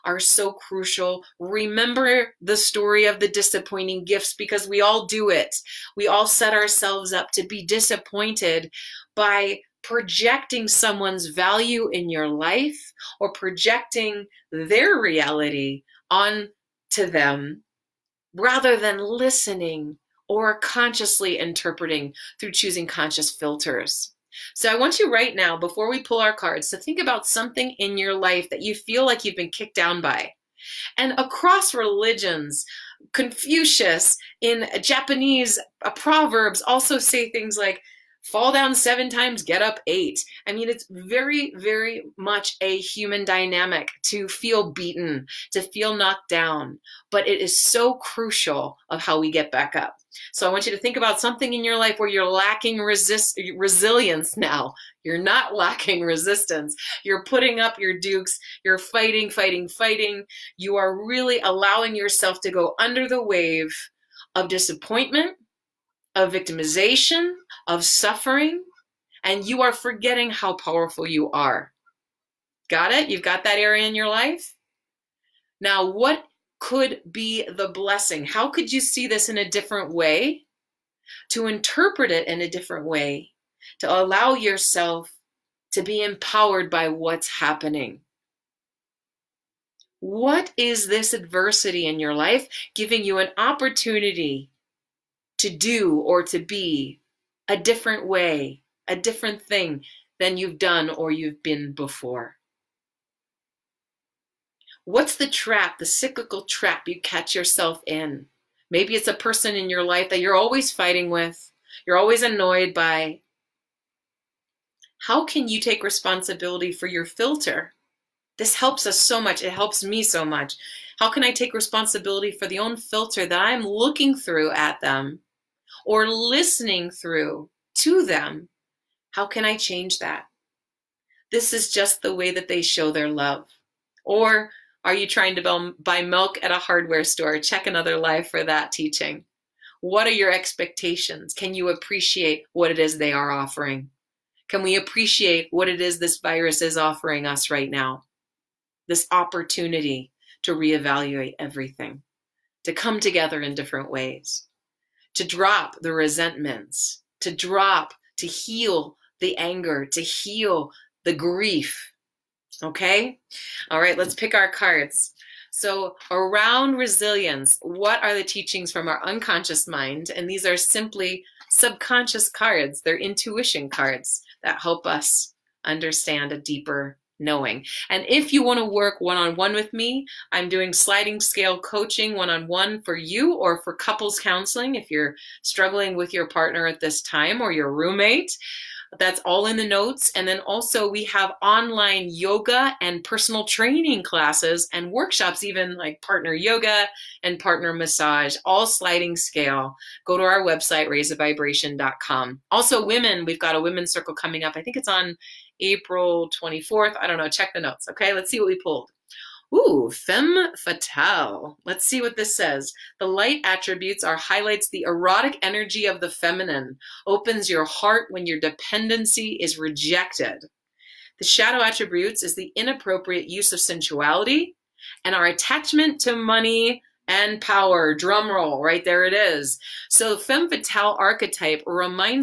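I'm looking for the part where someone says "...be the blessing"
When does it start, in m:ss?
1:17.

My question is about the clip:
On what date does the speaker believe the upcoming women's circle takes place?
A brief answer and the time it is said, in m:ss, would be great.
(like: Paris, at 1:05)
April 24th, at 3:25.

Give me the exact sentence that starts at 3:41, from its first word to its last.
The shadow attributes is the inappropriate use of sensuality and our attachment to money and power.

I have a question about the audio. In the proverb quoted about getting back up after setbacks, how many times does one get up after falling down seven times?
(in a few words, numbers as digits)
8.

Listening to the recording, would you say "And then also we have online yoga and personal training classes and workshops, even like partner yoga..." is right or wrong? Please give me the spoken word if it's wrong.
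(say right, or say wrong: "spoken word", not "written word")
right.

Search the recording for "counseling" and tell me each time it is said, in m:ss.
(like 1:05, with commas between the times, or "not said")
3:04.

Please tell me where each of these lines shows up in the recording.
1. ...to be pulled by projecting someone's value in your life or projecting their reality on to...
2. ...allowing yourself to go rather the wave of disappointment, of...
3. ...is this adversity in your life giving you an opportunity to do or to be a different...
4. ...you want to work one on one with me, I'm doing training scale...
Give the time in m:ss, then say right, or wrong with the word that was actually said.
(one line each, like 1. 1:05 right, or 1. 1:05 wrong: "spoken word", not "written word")
1. 0:07 wrong: "disappointed", not "pulled"
2. 1:01 wrong: "under", not "rather"
3. 1:30 right
4. 2:58 wrong: "sliding", not "training".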